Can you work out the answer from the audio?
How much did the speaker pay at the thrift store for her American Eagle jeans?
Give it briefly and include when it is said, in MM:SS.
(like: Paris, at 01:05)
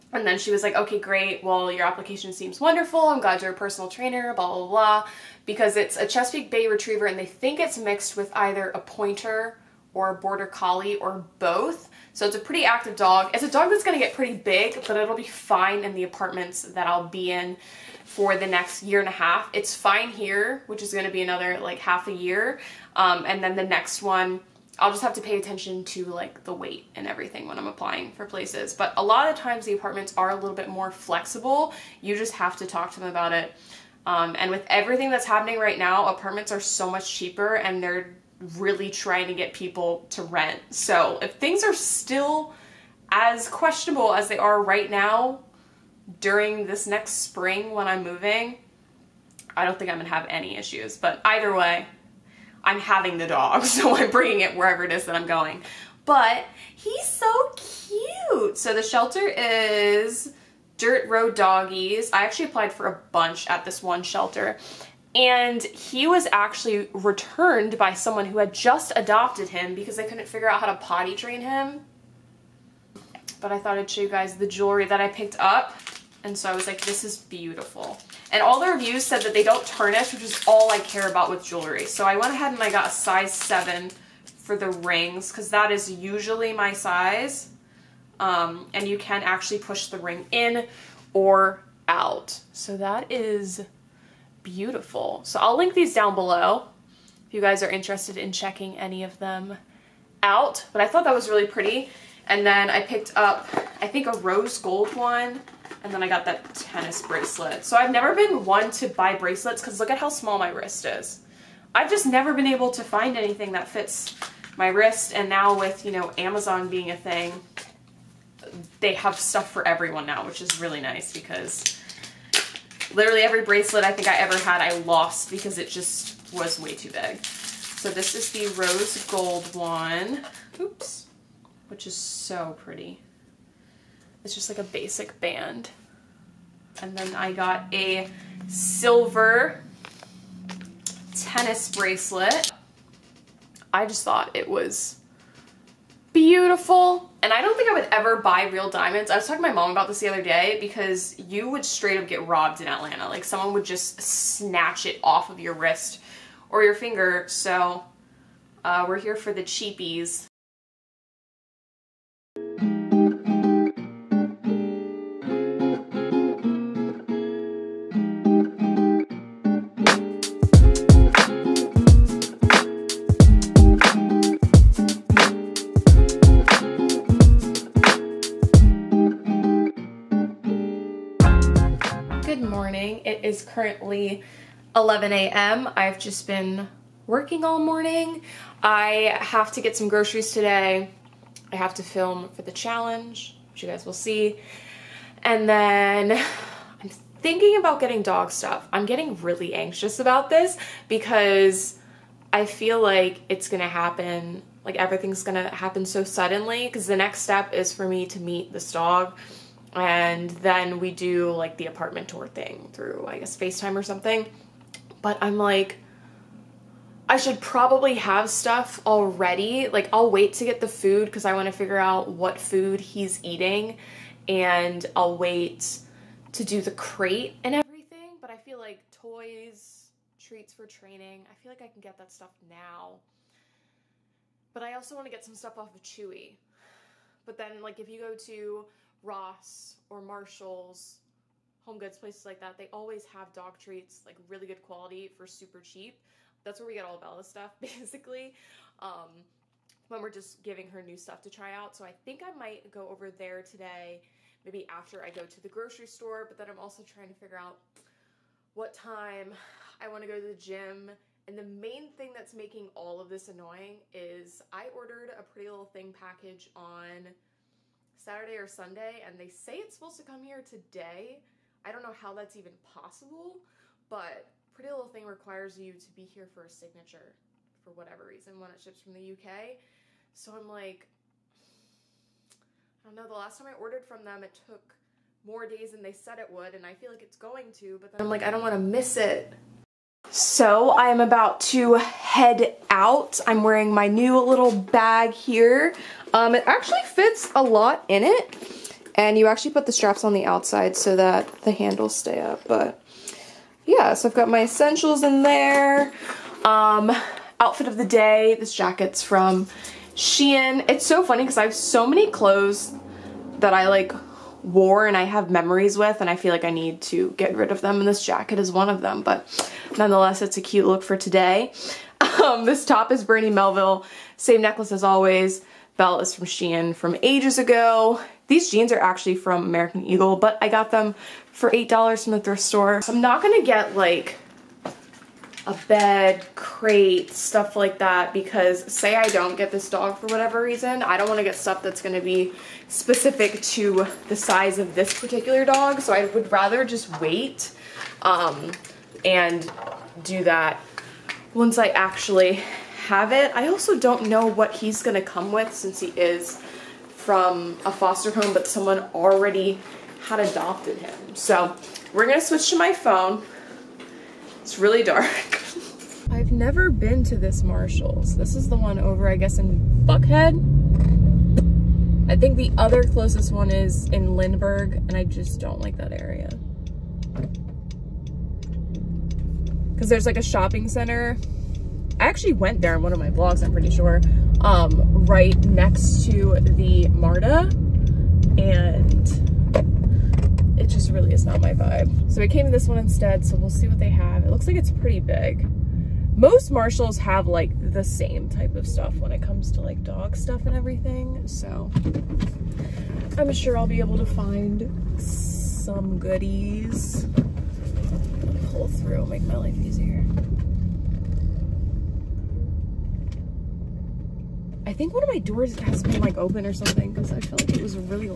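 $8, at 05:31.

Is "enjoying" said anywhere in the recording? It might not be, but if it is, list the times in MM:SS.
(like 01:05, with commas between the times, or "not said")
not said.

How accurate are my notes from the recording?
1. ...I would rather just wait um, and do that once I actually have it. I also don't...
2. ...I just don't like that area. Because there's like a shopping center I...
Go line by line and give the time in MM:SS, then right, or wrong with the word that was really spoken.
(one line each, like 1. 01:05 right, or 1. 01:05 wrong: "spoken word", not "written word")
1. 05:45 right
2. 06:14 right.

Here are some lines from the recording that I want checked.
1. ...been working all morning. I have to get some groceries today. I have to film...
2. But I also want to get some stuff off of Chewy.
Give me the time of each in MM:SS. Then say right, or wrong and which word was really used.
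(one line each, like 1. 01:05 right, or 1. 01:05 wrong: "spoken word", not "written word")
1. 03:06 right
2. 03:54 right.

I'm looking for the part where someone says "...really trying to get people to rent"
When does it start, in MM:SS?
00:38.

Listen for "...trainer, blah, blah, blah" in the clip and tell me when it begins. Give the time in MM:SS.
00:03.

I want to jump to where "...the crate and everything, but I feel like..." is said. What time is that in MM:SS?
03:46.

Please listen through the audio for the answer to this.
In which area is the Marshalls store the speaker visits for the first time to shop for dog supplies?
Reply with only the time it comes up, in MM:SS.
06:09.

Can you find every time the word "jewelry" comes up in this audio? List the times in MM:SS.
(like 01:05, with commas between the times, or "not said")
01:14, 01:21.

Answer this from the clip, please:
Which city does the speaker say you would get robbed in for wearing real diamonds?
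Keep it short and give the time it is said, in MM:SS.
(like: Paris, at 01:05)
Atlanta, at 02:32.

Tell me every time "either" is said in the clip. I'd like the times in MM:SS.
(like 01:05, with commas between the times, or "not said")
00:08, 00:51.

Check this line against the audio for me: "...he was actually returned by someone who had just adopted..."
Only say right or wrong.
right.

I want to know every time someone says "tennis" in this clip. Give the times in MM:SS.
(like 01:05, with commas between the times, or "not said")
01:46, 02:21.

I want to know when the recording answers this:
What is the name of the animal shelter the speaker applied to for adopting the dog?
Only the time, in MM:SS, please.
01:00.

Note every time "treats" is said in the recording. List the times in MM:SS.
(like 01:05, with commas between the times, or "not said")
03:50, 04:03.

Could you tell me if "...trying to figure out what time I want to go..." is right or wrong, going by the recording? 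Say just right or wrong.
right.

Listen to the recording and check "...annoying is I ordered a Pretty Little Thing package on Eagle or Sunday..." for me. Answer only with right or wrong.
wrong.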